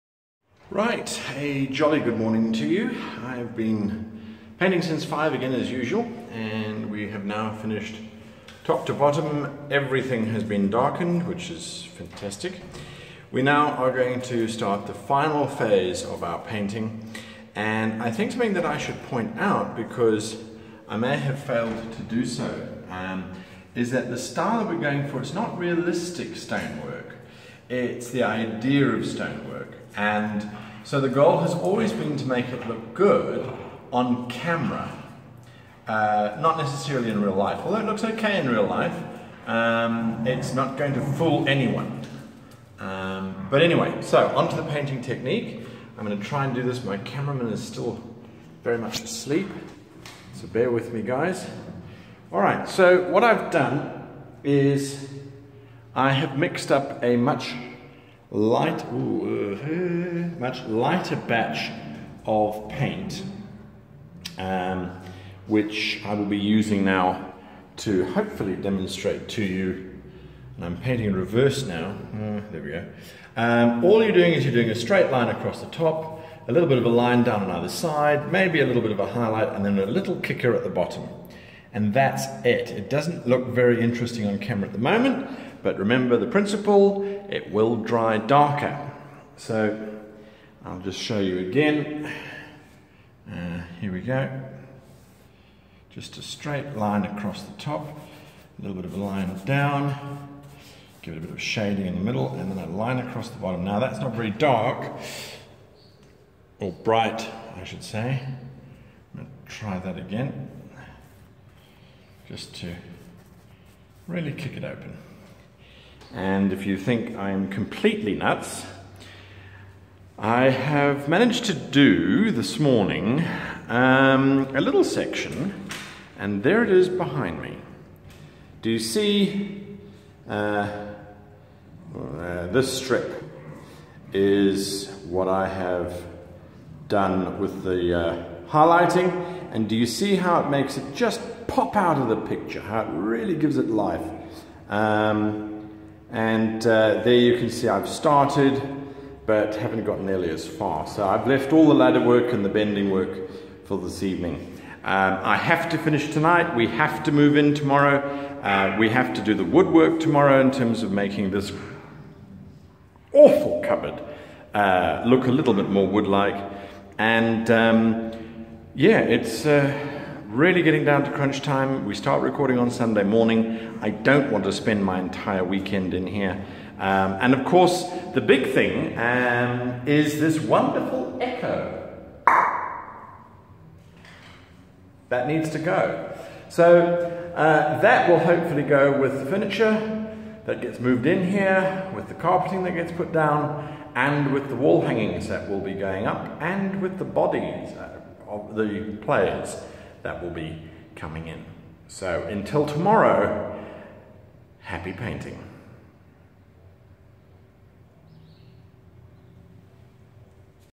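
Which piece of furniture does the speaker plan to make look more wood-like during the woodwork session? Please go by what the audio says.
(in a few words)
cupboard.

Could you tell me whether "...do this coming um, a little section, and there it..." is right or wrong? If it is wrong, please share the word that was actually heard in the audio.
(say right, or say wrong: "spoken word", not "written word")
wrong: "morning", not "coming".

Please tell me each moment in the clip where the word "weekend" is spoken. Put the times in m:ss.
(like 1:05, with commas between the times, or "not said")
2:55.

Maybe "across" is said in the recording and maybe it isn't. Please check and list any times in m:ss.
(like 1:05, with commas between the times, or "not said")
1:15, 1:37, 1:42.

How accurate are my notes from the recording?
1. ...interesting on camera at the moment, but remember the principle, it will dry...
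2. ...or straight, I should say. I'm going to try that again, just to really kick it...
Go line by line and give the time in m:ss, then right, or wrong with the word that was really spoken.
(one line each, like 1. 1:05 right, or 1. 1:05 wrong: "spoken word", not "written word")
1. 1:23 right
2. 1:46 wrong: "bright", not "straight".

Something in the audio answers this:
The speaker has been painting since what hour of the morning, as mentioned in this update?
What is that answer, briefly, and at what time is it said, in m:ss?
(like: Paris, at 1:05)
5, at 0:05.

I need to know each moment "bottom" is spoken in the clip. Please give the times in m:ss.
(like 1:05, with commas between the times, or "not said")
0:08, 1:20, 1:43.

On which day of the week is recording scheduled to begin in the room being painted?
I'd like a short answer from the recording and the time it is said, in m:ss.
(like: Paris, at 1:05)
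Sunday, at 2:52.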